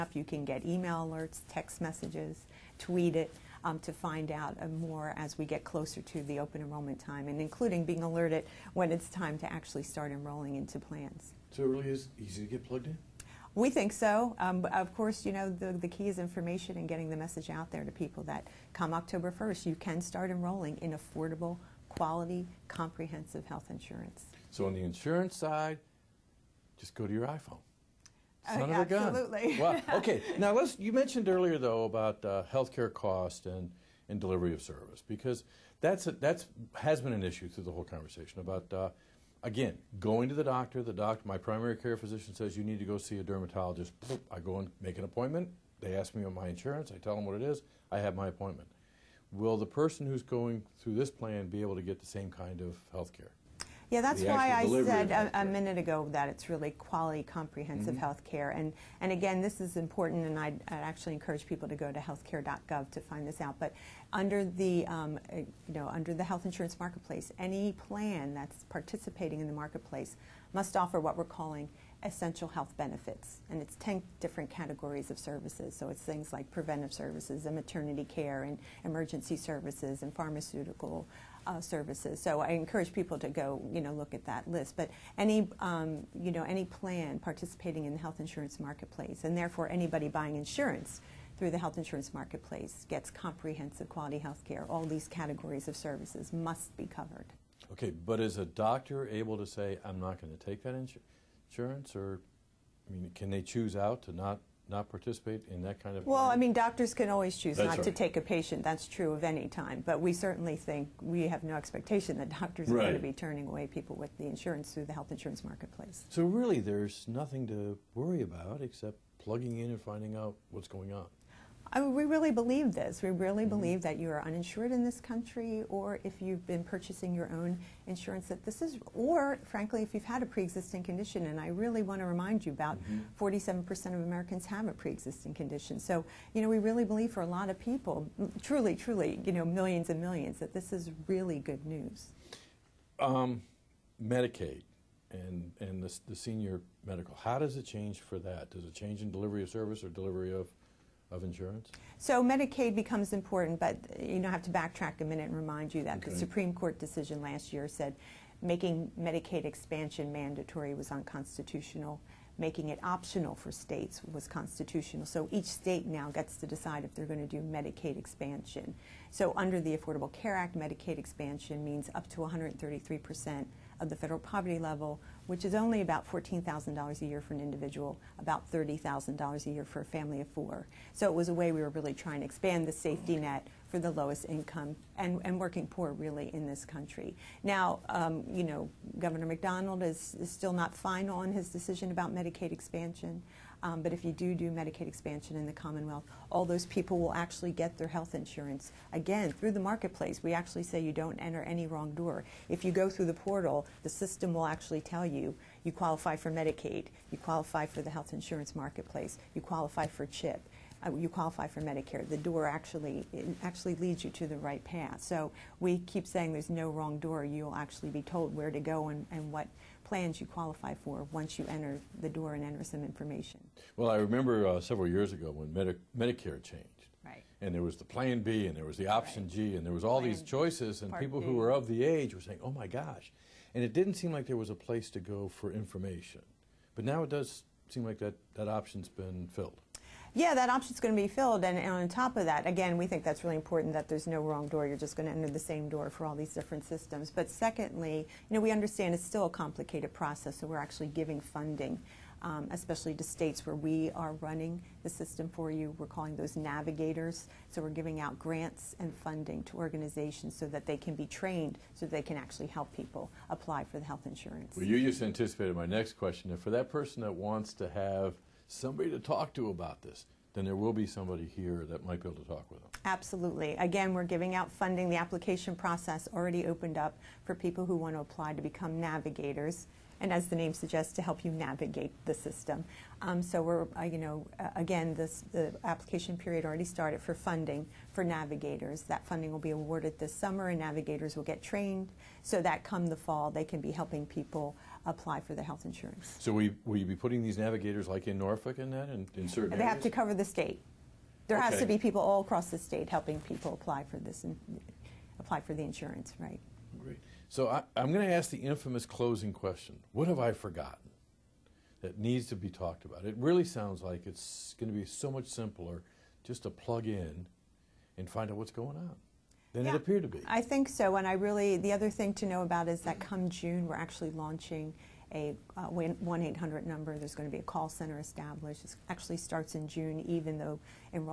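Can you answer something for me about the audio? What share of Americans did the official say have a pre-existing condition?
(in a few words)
47%.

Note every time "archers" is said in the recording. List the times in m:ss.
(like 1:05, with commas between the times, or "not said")
not said.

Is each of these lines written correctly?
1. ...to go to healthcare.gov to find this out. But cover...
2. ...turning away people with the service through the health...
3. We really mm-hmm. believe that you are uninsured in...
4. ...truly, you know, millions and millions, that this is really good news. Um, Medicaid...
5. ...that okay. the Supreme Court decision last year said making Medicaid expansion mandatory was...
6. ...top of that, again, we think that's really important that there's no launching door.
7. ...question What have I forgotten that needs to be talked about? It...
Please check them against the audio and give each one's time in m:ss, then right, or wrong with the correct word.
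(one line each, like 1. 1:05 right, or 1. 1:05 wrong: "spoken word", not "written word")
1. 1:01 wrong: "under", not "cover"
2. 1:53 wrong: "insurance", not "service"
3. 2:03 right
4. 2:18 right
5. 2:35 right
6. 4:01 wrong: "wrong", not "launching"
7. 5:09 right.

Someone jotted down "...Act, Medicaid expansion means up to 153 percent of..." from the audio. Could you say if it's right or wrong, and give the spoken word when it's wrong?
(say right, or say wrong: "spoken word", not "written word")
wrong: "133", not "153".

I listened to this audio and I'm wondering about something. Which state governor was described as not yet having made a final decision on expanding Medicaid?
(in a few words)
Governor McDonnell.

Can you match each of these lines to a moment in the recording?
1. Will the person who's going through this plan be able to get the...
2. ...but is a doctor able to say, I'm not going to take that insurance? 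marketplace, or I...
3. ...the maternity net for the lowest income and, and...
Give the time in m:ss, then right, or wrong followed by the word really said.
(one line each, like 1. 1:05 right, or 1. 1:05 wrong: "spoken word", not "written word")
1. 0:49 right
2. 1:38 wrong: "insurance", not "marketplace"
3. 3:02 wrong: "safety", not "maternity".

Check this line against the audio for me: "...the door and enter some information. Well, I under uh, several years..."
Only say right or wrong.
wrong.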